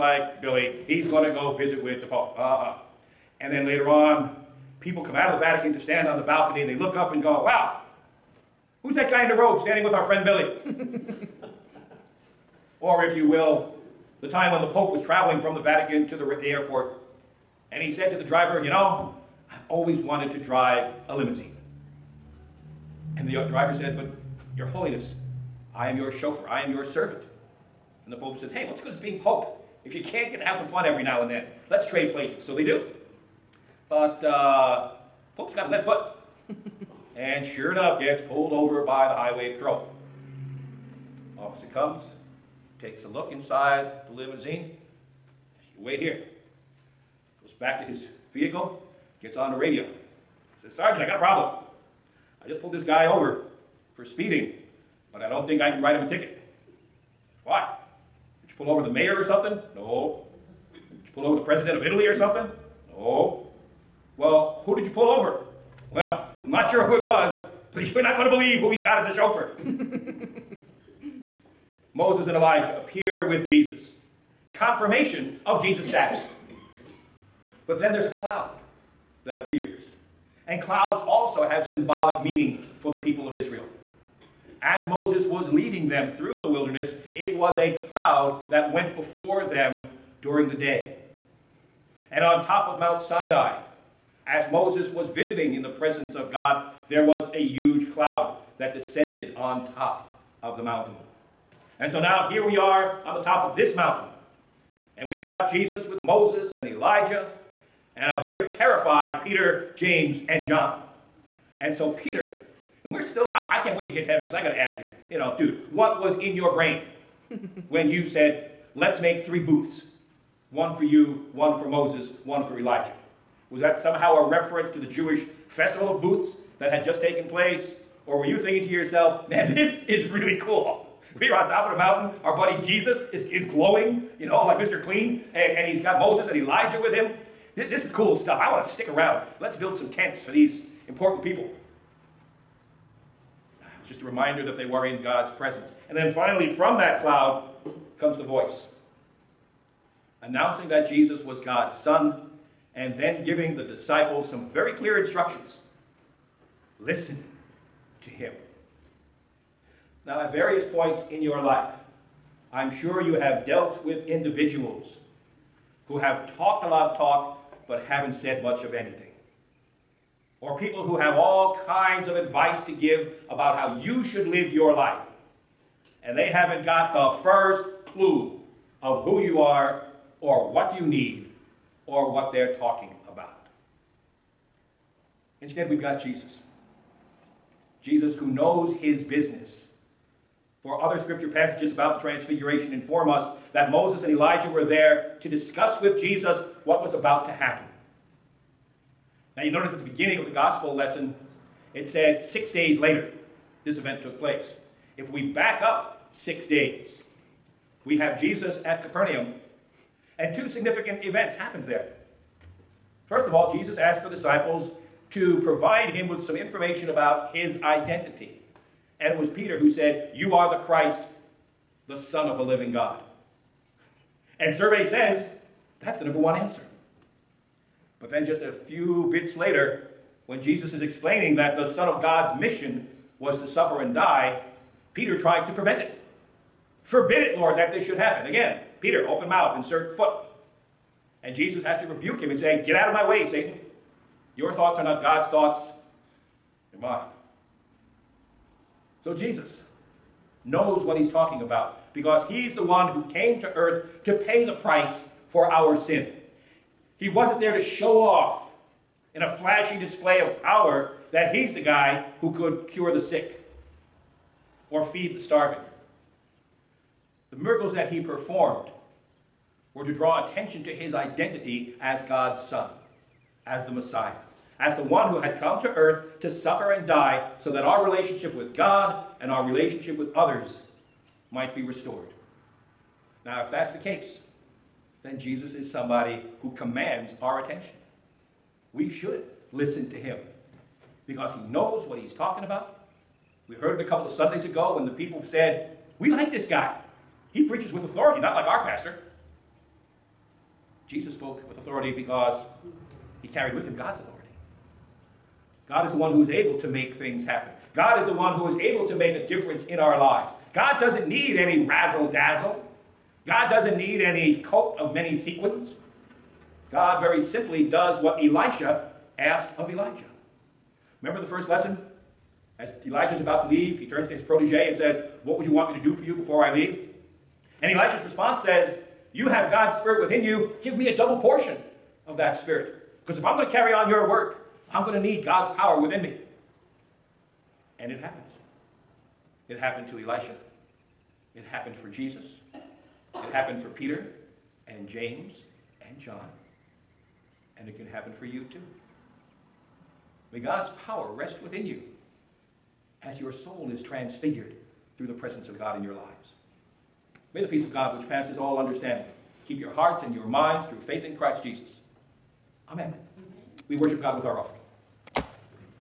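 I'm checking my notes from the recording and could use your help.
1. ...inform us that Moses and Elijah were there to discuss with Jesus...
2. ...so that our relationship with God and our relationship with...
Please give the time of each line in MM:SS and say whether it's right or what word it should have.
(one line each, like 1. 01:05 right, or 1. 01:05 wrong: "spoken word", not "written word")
1. 03:12 right
2. 04:37 right.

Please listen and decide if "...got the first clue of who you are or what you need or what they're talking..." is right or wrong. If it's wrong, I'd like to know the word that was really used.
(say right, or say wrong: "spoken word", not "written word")
right.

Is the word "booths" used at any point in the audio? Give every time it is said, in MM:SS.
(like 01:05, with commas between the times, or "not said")
01:59, 02:06.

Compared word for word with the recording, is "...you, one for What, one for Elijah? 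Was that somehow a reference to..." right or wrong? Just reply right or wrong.
wrong.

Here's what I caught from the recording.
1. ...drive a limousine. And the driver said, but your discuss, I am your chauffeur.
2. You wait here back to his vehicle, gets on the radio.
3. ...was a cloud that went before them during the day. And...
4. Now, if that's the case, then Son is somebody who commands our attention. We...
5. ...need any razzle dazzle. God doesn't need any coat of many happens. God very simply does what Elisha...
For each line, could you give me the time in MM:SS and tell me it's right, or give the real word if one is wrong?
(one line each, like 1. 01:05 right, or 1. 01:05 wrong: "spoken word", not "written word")
1. 00:20 wrong: "holiness", not "discuss"
2. 00:45 right
3. 01:27 right
4. 04:43 wrong: "Jesus", not "Son"
5. 05:11 wrong: "sequins", not "happens".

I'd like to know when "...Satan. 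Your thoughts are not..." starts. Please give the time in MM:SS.
04:03.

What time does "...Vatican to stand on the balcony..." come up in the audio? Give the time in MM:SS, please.
00:05.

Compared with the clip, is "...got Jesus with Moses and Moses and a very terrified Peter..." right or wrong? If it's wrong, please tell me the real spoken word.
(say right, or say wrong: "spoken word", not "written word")
wrong: "Elijah", not "Moses".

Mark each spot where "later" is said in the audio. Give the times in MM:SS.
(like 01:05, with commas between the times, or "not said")
00:03, 03:22, 03:49.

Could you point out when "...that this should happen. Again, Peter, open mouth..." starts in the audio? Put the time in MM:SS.
03:57.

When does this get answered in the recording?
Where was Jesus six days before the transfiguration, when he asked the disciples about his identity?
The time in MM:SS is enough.
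03:28.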